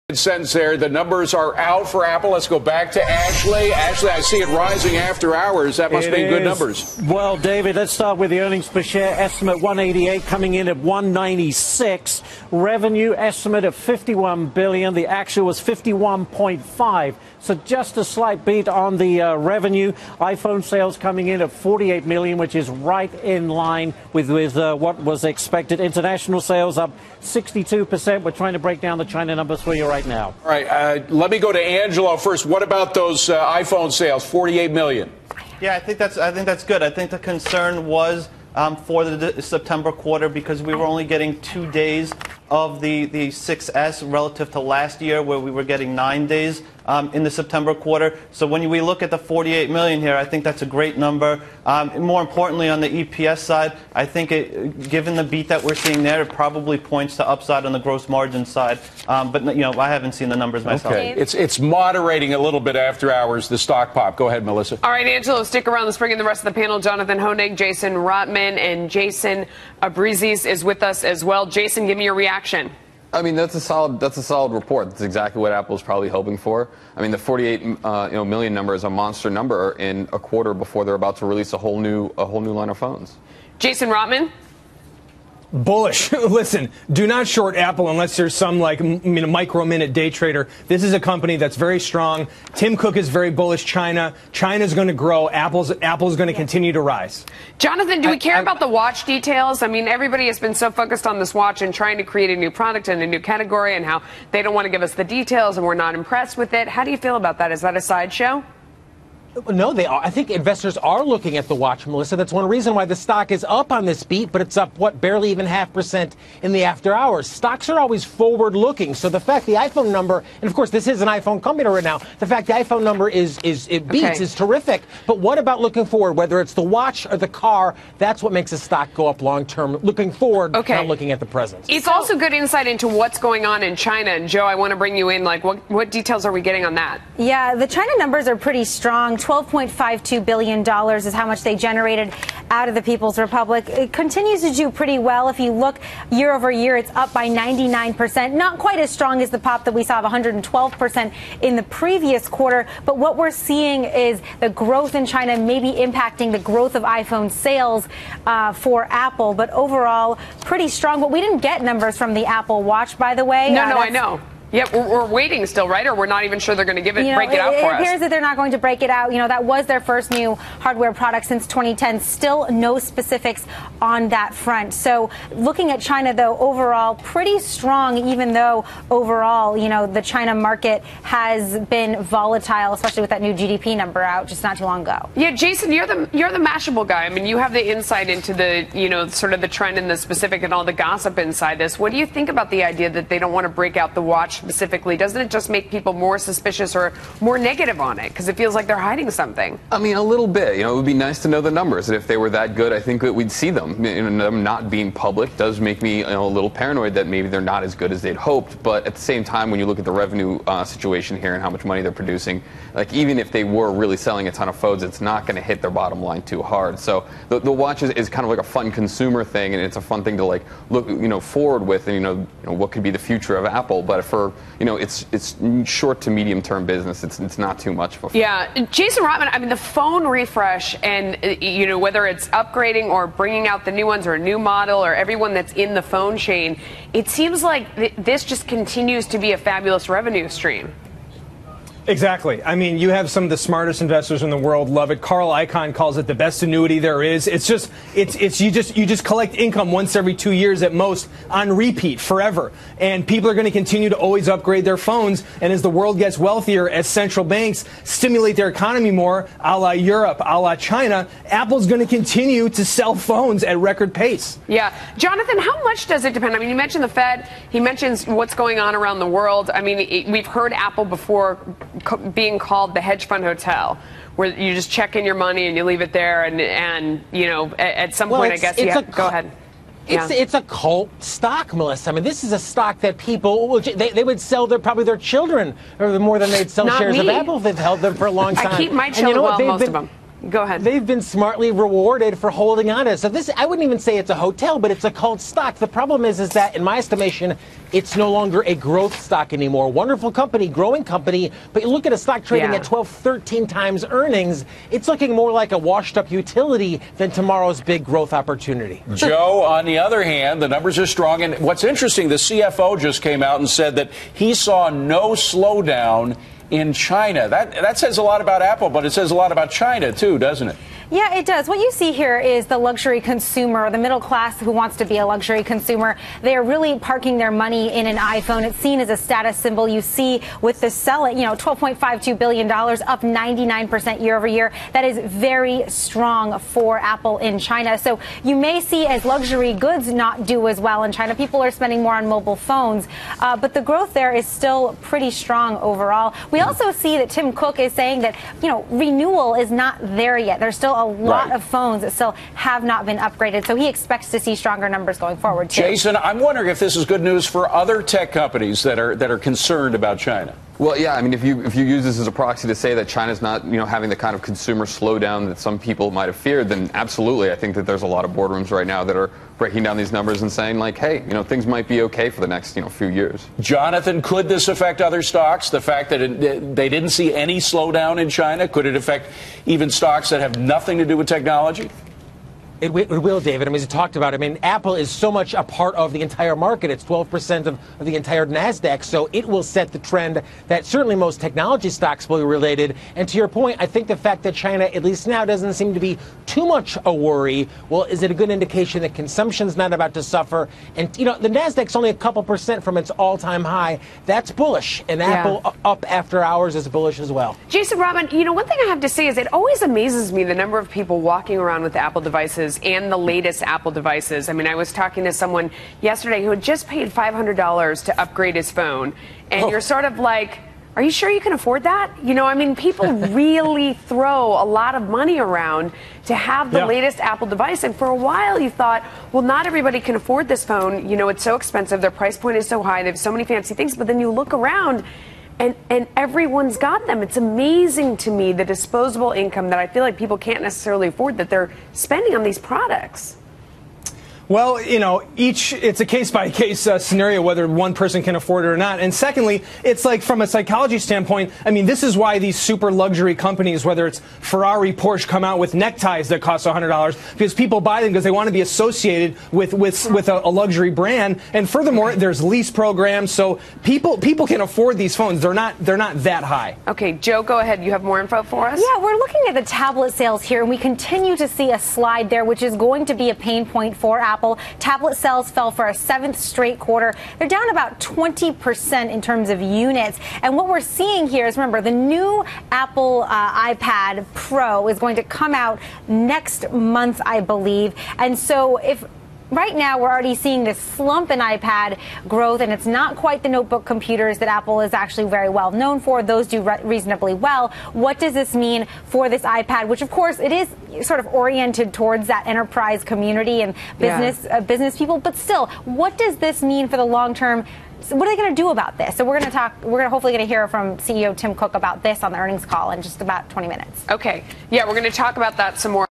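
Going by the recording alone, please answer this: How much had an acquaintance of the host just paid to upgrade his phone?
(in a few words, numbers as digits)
$500.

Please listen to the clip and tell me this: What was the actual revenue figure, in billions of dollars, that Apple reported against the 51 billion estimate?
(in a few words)
51.5.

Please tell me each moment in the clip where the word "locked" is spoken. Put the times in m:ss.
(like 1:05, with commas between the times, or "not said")
not said.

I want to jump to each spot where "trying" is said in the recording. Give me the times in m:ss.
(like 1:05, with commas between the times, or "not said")
0:28, 1:41.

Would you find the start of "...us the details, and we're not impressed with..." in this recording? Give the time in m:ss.
1:44.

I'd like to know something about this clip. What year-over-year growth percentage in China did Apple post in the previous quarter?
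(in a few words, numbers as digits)
112%.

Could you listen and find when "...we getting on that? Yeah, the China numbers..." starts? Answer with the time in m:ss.
2:16.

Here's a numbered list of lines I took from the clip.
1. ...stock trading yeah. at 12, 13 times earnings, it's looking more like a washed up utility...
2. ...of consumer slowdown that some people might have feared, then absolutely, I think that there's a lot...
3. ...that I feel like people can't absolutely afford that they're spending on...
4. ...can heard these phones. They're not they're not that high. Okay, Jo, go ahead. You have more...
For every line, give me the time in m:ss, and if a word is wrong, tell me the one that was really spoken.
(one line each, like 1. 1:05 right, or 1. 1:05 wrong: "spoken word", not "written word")
1. 5:01 right
2. 6:04 right
3. 7:19 wrong: "necessarily", not "absolutely"
4. 7:44 wrong: "afford", not "heard".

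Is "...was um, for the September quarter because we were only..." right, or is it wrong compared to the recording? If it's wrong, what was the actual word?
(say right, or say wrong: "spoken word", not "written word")
right.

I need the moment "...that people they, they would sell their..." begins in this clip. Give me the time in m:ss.
4:42.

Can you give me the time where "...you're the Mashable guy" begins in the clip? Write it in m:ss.
3:06.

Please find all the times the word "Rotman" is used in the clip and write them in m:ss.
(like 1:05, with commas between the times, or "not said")
1:07, 1:23, 3:49.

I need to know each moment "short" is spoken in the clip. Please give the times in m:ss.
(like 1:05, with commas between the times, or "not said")
1:27, 3:45.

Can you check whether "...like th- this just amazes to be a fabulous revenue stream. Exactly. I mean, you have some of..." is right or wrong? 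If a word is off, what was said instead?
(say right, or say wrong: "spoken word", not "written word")
wrong: "continues", not "amazes".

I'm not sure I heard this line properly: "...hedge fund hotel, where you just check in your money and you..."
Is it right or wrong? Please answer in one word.
right.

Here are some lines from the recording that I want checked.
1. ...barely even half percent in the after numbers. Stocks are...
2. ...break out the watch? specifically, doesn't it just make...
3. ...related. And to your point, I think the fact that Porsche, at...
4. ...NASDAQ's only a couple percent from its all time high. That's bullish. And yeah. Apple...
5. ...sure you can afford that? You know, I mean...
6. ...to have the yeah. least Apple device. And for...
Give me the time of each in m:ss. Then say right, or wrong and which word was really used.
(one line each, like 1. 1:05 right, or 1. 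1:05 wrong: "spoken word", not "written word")
1. 1:54 wrong: "hours", not "numbers"
2. 3:13 right
3. 6:32 wrong: "China", not "Porsche"
4. 6:41 right
5. 7:00 right
6. 7:06 wrong: "latest", not "least".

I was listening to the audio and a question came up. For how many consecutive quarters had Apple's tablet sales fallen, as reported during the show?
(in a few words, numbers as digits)
7.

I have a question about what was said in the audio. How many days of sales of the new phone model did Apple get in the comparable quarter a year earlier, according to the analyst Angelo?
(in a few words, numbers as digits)
9.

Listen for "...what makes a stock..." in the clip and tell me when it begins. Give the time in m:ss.
2:08.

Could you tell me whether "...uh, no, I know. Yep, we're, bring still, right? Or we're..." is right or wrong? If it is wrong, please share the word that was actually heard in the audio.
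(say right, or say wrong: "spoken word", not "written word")
wrong: "waiting", not "bring".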